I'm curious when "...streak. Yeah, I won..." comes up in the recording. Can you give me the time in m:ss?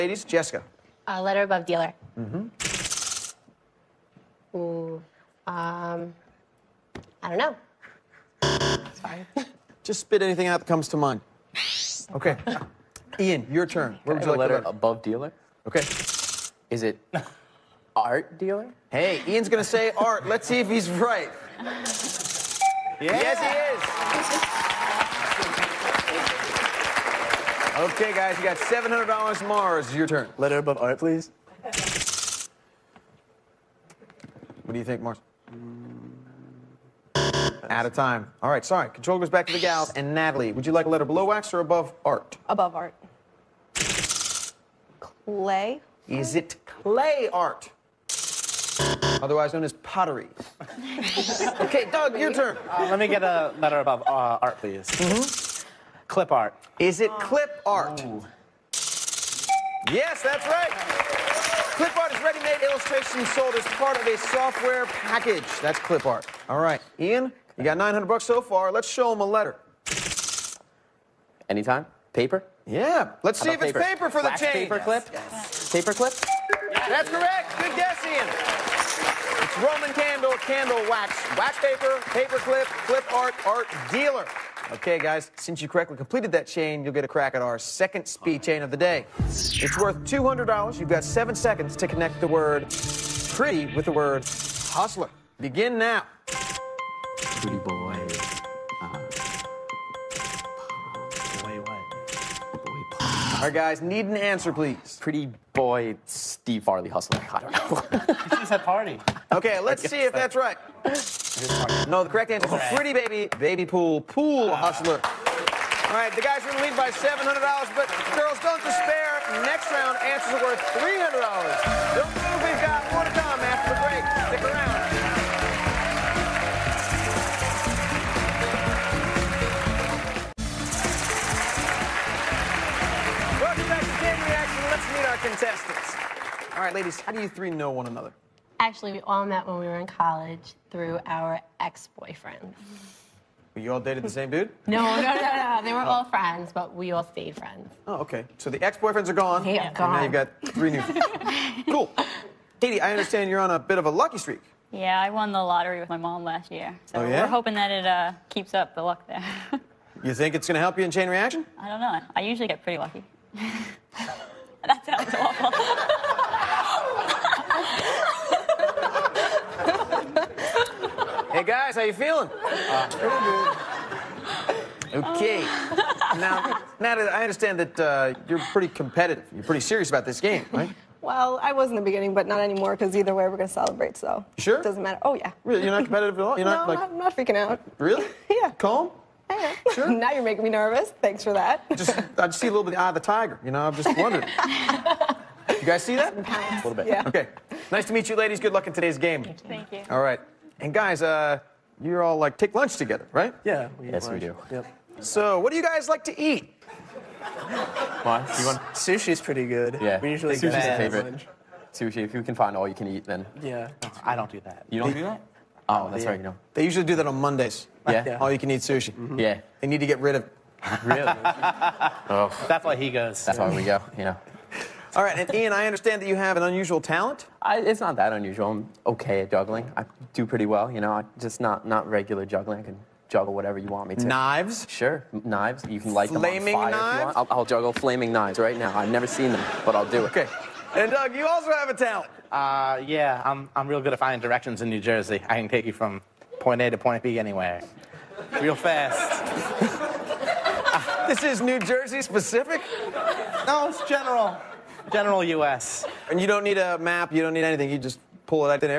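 2:34.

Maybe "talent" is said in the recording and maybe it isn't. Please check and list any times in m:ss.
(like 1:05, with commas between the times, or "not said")
3:46, 4:01.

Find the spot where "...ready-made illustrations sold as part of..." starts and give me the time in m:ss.
1:02.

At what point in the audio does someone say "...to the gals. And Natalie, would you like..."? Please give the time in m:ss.
0:39.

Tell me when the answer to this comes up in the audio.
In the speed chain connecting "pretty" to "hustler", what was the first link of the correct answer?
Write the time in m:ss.
1:52.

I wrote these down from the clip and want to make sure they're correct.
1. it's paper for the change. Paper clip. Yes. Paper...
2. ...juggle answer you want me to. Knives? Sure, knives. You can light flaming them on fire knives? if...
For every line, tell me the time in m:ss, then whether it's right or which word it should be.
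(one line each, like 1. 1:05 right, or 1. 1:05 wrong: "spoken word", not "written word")
1. 1:13 right
2. 3:53 wrong: "whatever", not "answer".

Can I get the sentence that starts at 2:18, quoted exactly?
Actually, we all met when we were in college through our ex-boyfriends.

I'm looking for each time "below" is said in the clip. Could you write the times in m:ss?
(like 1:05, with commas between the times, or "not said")
0:41.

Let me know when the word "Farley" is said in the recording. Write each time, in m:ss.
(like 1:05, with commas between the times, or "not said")
1:46.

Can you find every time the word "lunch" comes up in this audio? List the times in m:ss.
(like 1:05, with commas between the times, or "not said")
3:22, 3:31.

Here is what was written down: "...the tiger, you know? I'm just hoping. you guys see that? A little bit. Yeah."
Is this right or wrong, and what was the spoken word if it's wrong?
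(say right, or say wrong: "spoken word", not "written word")
wrong: "wondering", not "hoping".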